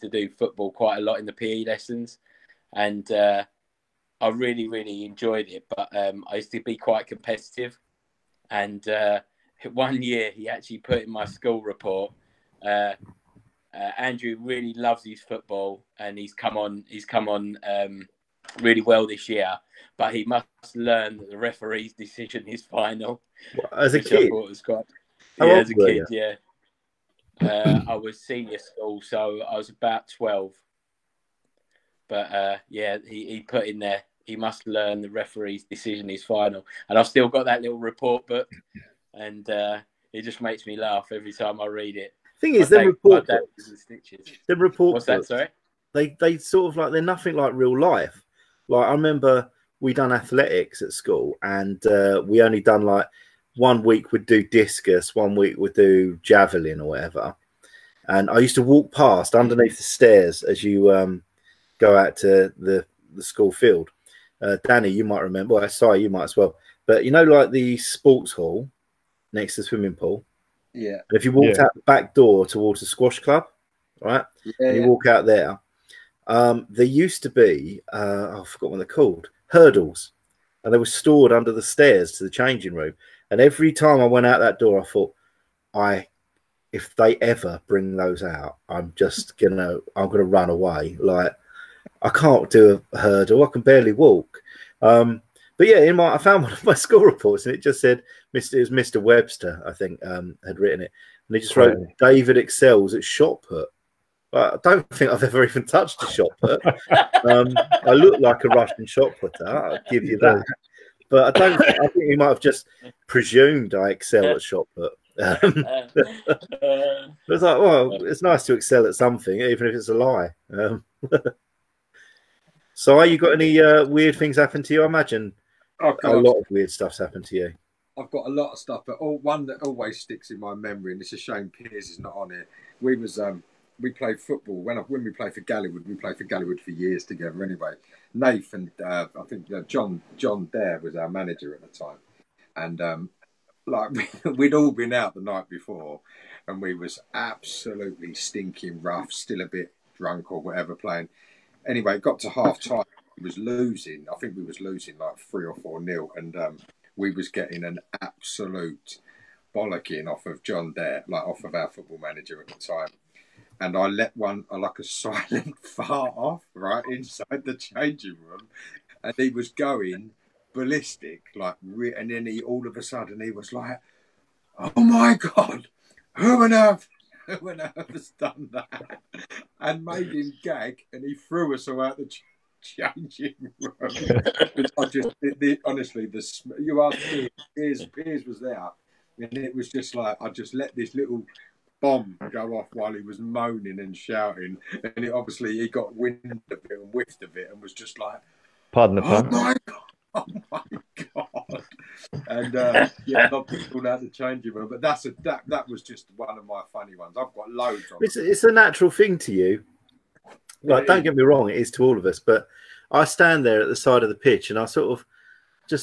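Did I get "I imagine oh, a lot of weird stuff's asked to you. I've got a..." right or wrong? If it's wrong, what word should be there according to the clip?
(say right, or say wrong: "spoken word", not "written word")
wrong: "happened", not "asked".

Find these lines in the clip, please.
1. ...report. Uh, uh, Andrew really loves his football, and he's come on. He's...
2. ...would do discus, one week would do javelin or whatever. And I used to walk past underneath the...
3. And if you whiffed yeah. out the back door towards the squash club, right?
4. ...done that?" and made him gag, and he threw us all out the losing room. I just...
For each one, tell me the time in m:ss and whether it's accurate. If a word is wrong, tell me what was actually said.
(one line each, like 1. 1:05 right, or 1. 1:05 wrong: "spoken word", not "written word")
1. 0:11 right
2. 0:54 right
3. 1:11 wrong: "walked", not "whiffed"
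4. 2:58 wrong: "changing", not "losing".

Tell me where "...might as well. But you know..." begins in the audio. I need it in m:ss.
1:06.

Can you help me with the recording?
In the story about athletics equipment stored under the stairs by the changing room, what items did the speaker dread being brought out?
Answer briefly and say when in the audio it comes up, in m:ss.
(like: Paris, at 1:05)
Hurdles, at 1:19.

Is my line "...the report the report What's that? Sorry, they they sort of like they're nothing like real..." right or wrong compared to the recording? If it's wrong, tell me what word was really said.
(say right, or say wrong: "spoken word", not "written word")
right.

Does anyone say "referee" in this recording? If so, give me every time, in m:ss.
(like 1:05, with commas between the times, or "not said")
0:21, 0:35.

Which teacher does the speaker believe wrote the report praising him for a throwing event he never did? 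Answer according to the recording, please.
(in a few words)
Mr. Webster.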